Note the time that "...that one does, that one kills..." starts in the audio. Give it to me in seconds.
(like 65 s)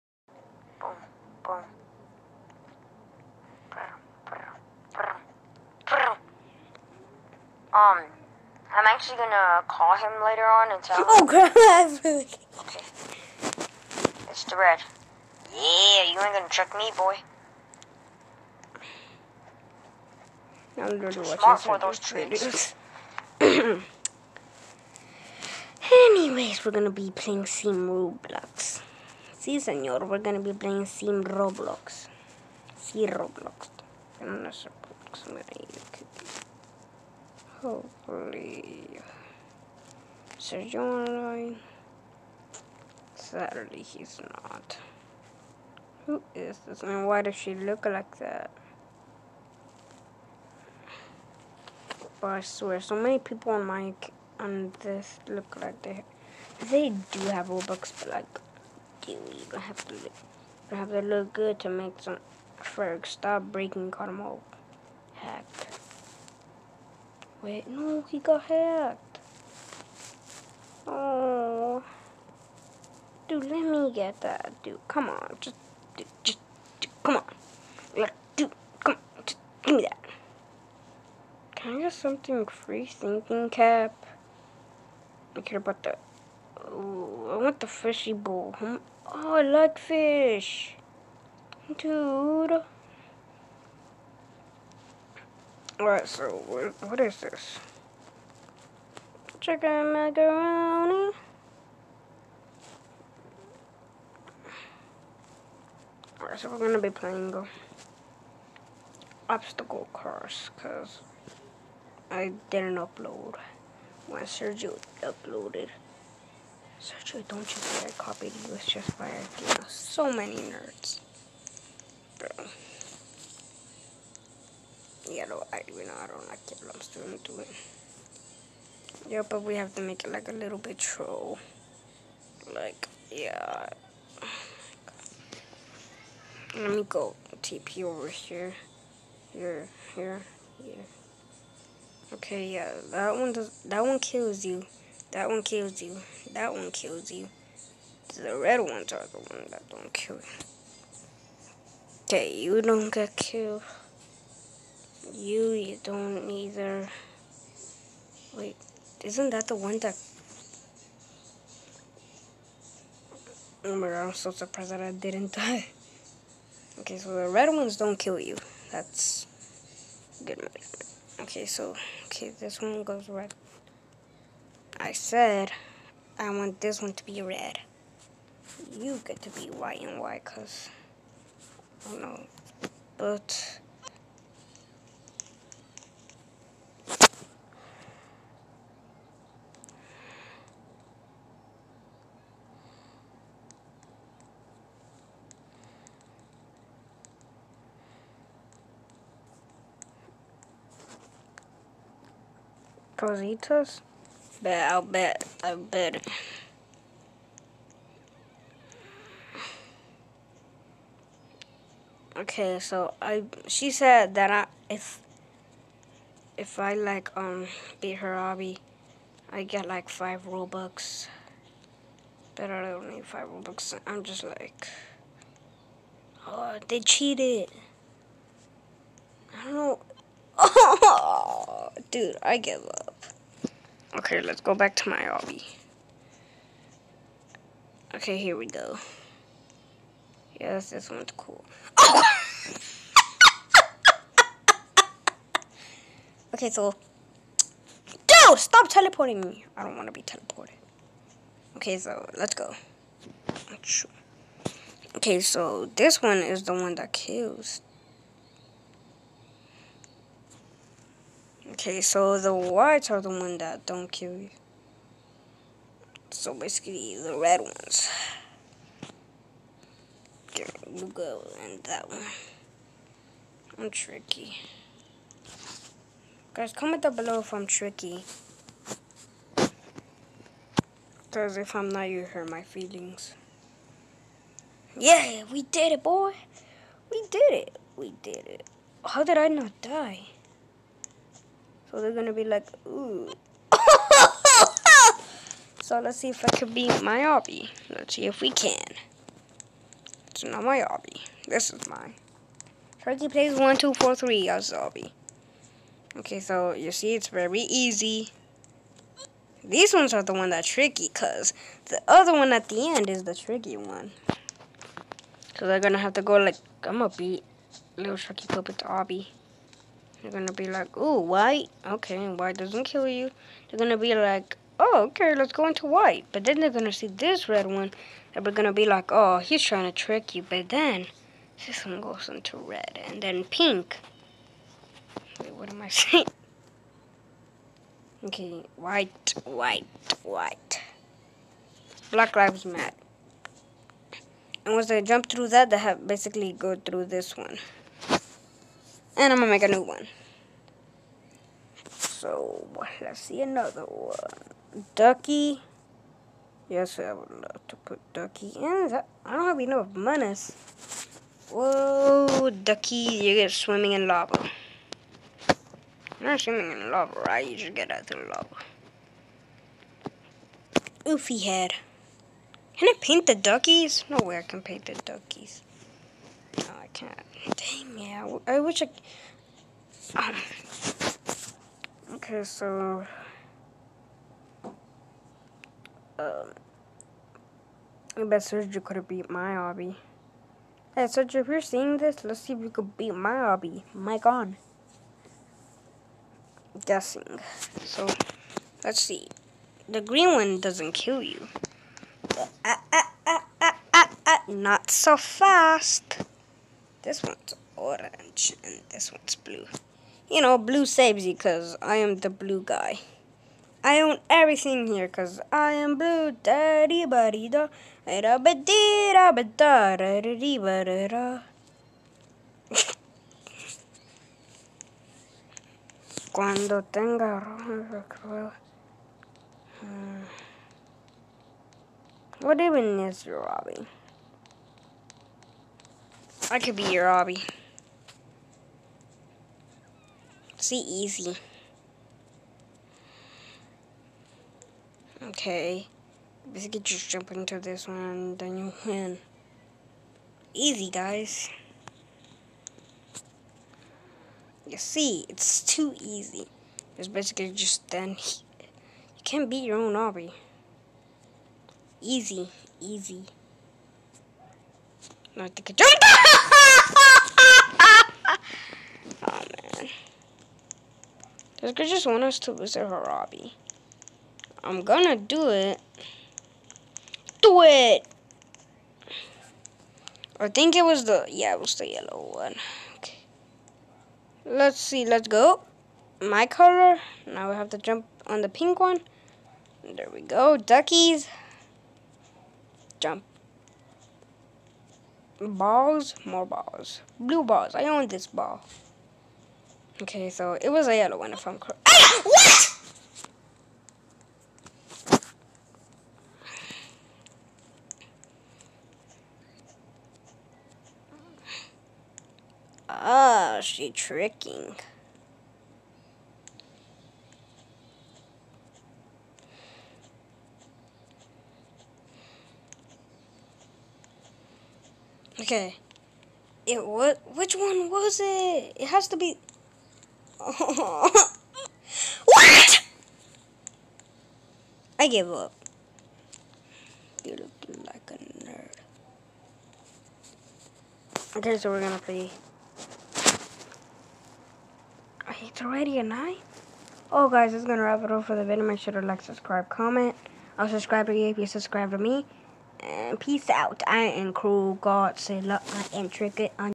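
142 s.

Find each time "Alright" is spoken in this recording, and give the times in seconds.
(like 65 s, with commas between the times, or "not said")
95 s, 106 s.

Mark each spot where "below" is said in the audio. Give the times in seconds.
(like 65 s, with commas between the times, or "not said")
276 s.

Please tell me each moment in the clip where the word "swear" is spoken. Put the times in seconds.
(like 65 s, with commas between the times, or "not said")
52 s.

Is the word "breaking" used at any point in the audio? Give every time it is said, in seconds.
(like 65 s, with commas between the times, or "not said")
63 s.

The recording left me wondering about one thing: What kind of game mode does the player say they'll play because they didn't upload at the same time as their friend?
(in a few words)
Obstacle course.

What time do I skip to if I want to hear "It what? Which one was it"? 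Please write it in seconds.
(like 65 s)
526 s.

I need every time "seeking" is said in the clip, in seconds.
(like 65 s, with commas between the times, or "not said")
not said.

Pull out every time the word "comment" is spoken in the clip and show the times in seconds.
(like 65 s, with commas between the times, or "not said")
276 s, 549 s.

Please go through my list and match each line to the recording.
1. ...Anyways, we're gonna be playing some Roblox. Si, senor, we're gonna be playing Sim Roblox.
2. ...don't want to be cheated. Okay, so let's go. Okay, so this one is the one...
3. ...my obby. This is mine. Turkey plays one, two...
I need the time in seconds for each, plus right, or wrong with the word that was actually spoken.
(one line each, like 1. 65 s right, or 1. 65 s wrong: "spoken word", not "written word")
1. 25 s right
2. 249 s wrong: "teleported", not "cheated"
3. 300 s right.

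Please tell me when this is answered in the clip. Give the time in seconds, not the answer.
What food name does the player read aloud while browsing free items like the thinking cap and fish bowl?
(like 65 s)
99 s.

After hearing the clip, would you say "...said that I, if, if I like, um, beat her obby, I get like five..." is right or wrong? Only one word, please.
right.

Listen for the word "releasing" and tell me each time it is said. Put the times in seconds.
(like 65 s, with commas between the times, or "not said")
not said.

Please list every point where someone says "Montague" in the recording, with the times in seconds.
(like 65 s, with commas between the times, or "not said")
not said.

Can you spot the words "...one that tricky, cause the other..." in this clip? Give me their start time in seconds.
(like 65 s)
310 s.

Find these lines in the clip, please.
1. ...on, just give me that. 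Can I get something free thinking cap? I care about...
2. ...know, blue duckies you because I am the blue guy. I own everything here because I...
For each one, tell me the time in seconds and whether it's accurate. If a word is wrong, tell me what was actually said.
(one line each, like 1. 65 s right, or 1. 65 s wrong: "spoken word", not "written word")
1. 78 s right
2. 410 s wrong: "saves", not "duckies".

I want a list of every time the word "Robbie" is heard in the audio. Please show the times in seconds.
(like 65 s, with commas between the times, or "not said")
433 s.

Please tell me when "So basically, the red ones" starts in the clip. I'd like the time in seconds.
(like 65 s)
266 s.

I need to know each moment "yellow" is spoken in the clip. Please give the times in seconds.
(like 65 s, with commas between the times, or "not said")
481 s, 500 s.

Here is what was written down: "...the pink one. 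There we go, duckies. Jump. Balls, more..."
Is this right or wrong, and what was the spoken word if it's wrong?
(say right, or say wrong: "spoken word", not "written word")
right.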